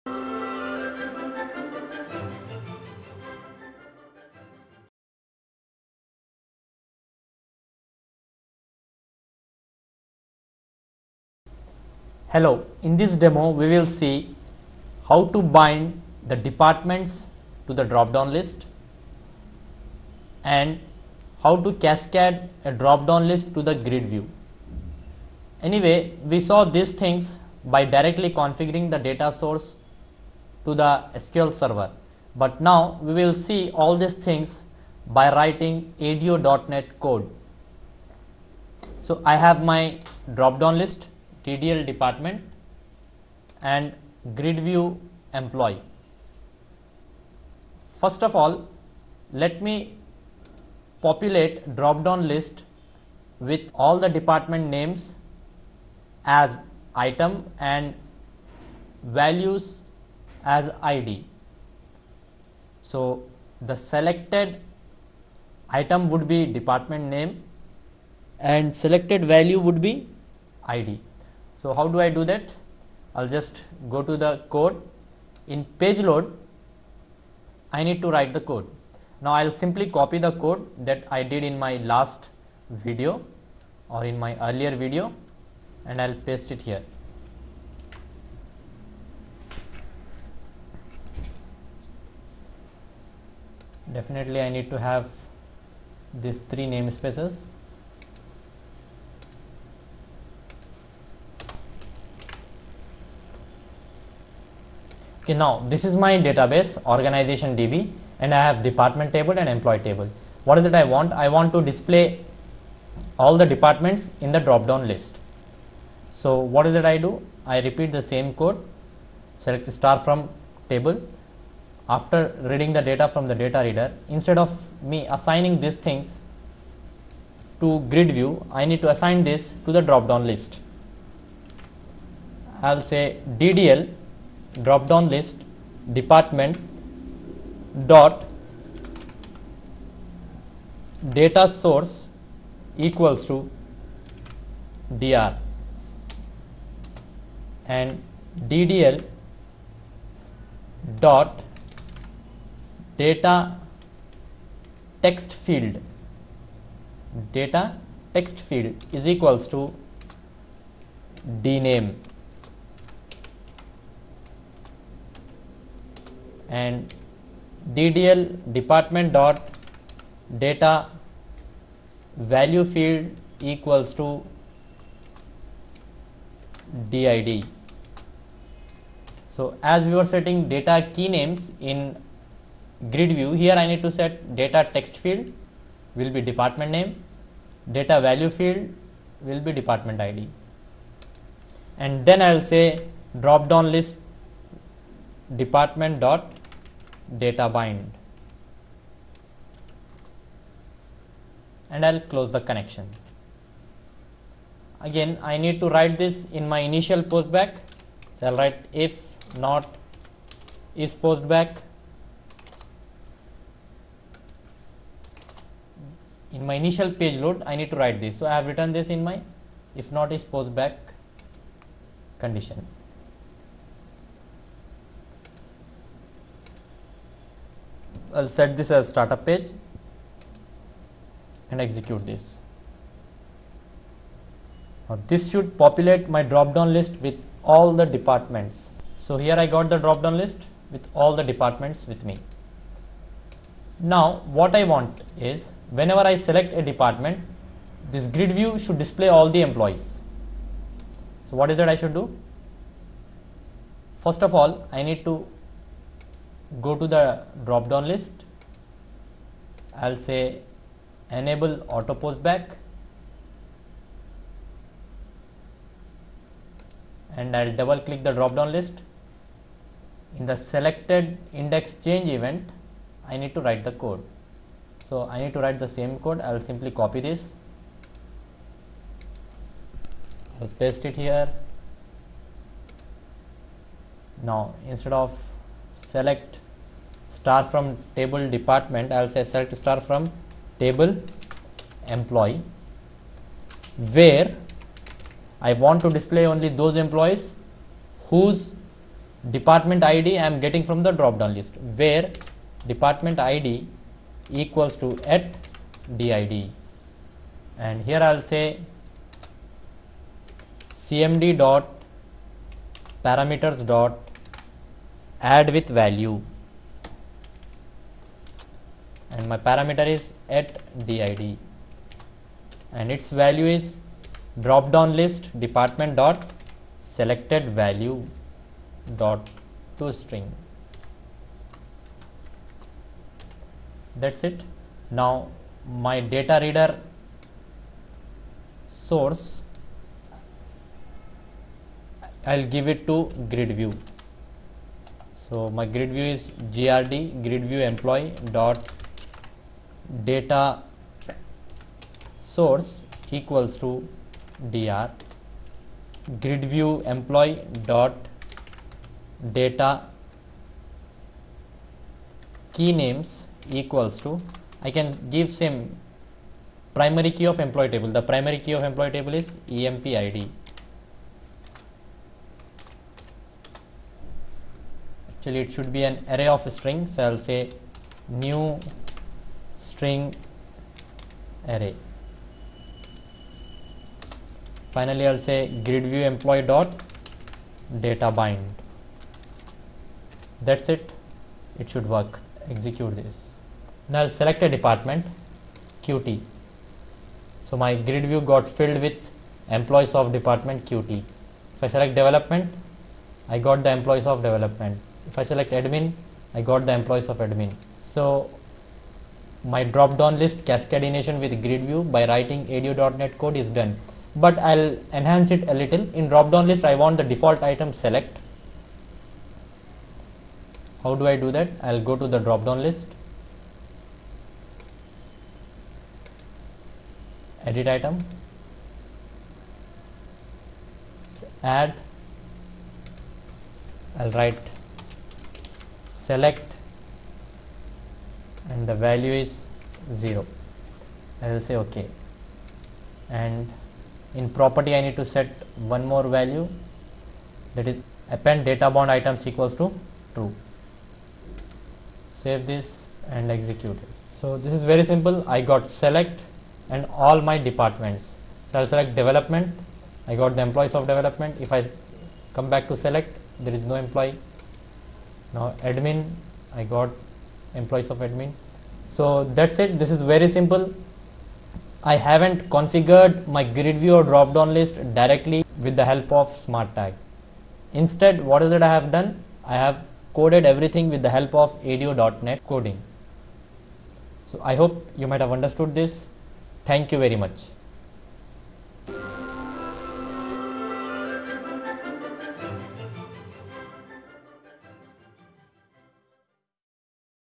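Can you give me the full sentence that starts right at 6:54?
But I'll enhance it a little.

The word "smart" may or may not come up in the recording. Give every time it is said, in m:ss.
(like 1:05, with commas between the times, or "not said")
7:56.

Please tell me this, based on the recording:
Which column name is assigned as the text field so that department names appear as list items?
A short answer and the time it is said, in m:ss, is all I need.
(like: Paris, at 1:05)
dname, at 2:41.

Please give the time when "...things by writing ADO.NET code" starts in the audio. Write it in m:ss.
0:34.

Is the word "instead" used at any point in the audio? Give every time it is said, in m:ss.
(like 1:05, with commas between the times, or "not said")
2:04, 4:44, 7:57.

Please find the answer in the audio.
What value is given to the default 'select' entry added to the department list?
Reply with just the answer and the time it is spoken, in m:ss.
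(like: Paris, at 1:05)
0, at 7:19.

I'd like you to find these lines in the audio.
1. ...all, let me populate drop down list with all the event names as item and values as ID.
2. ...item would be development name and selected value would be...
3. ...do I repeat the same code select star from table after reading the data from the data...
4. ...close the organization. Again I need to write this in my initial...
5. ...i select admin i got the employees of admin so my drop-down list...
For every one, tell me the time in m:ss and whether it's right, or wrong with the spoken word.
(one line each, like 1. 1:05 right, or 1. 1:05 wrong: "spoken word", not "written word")
1. 0:48 wrong: "department", not "event"
2. 1:05 wrong: "department", not "development"
3. 1:56 right
4. 3:21 wrong: "connection", not "organization"
5. 6:45 right.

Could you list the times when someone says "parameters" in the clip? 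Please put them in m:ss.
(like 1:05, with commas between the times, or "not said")
5:13, 5:19.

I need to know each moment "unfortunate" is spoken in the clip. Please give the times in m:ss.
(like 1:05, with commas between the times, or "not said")
not said.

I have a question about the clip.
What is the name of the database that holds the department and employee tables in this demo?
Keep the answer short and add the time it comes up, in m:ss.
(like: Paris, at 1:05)
organization DB, at 1:46.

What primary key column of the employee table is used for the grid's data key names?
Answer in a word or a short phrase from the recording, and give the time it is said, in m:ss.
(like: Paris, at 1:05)
emp id, at 6:09.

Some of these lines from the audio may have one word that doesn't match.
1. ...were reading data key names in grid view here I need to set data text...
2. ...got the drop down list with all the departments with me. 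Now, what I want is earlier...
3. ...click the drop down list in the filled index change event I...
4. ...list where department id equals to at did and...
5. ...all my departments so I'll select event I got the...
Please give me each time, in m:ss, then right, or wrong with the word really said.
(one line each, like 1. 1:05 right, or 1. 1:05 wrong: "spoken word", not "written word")
1. 2:59 wrong: "setting", not "reading"
2. 3:59 wrong: "whenever", not "earlier"
3. 4:27 wrong: "selected", not "filled"
4. 5:01 right
5. 7:37 wrong: "development", not "event".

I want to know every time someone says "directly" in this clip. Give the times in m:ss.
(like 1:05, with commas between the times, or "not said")
0:27, 7:54.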